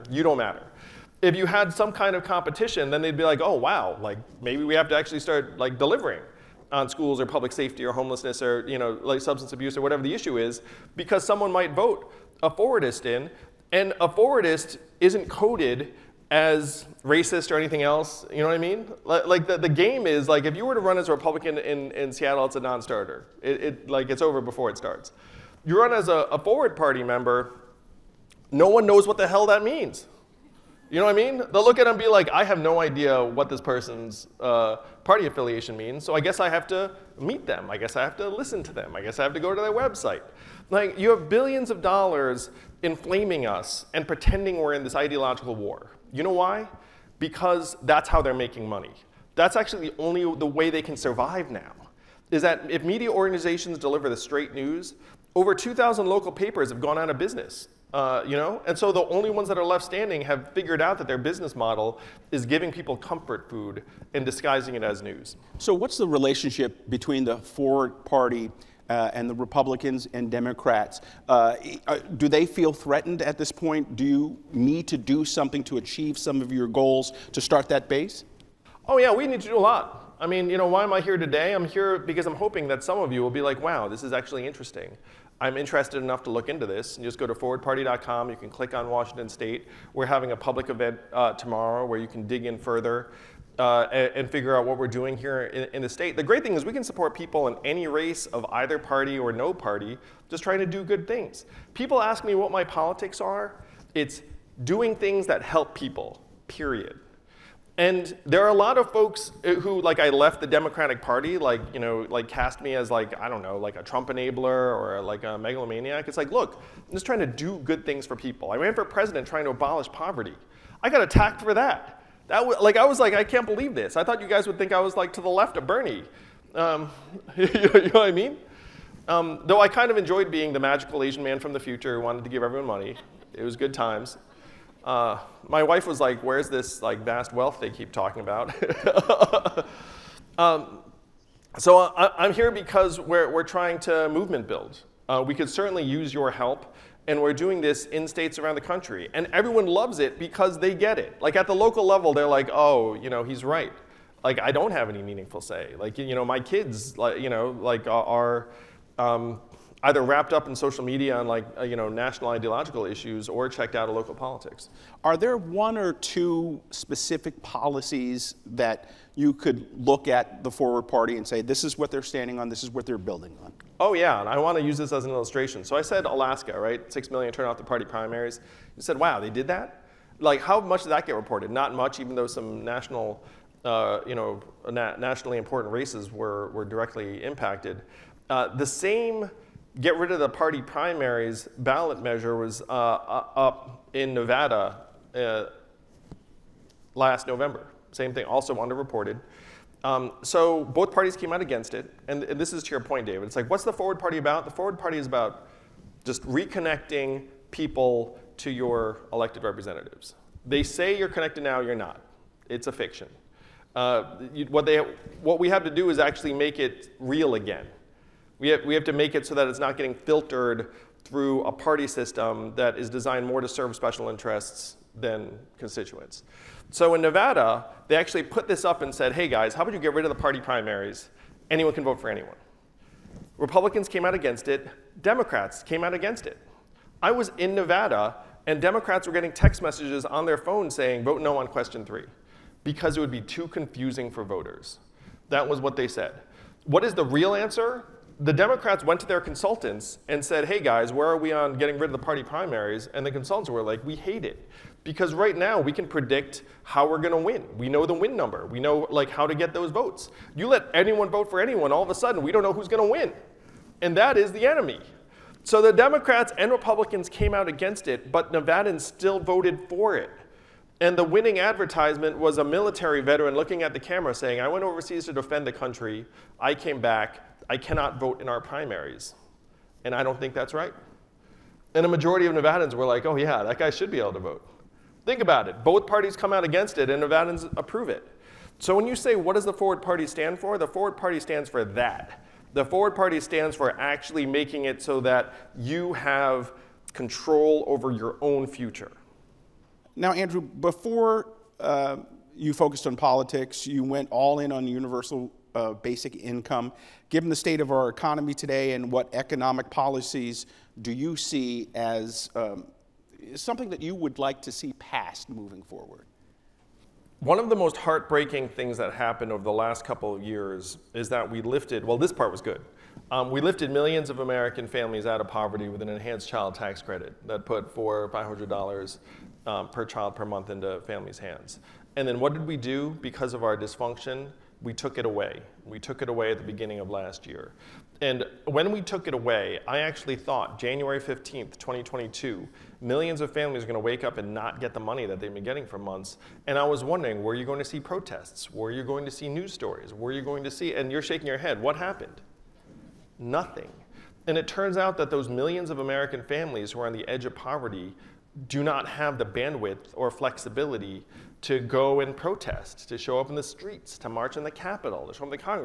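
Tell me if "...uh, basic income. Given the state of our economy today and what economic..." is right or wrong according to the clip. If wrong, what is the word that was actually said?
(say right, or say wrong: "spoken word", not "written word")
right.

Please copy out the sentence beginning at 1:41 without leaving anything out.
People ask me what my politics are.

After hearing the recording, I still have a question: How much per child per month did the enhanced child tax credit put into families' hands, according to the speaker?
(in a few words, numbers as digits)
400 or 500 dollars.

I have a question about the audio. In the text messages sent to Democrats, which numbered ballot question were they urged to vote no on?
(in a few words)
question 3.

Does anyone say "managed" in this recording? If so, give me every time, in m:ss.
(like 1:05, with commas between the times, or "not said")
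not said.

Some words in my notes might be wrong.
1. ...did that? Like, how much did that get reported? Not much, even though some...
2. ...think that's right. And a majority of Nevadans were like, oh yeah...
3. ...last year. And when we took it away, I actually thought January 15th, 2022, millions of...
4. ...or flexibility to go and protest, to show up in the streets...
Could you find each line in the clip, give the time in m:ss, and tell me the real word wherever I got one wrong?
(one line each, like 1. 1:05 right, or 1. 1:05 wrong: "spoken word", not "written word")
1. 2:59 right
2. 4:40 right
3. 5:36 right
4. 5:59 right.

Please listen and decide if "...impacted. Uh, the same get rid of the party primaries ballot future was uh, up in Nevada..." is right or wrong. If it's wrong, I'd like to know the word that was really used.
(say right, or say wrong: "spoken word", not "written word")
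wrong: "measure", not "future".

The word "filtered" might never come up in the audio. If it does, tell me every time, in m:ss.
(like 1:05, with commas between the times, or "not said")
3:39.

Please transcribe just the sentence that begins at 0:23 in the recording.
It, it, like it's over before it starts.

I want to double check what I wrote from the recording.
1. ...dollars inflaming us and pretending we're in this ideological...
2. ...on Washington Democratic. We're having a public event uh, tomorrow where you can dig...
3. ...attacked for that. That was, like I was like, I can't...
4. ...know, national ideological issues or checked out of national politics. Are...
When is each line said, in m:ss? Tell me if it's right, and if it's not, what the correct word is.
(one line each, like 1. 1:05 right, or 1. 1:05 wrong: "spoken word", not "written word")
1. 0:41 right
2. 1:28 wrong: "State", not "Democratic"
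3. 2:01 right
4. 2:41 wrong: "local", not "national".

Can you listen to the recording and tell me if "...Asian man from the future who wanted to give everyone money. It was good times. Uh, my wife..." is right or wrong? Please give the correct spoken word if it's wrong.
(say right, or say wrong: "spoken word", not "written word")
right.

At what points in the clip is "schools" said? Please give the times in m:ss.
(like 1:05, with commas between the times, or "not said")
0:06.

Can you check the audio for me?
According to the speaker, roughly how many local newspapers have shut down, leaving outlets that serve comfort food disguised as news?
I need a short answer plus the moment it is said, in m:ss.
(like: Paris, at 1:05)
over 2,000, at 0:55.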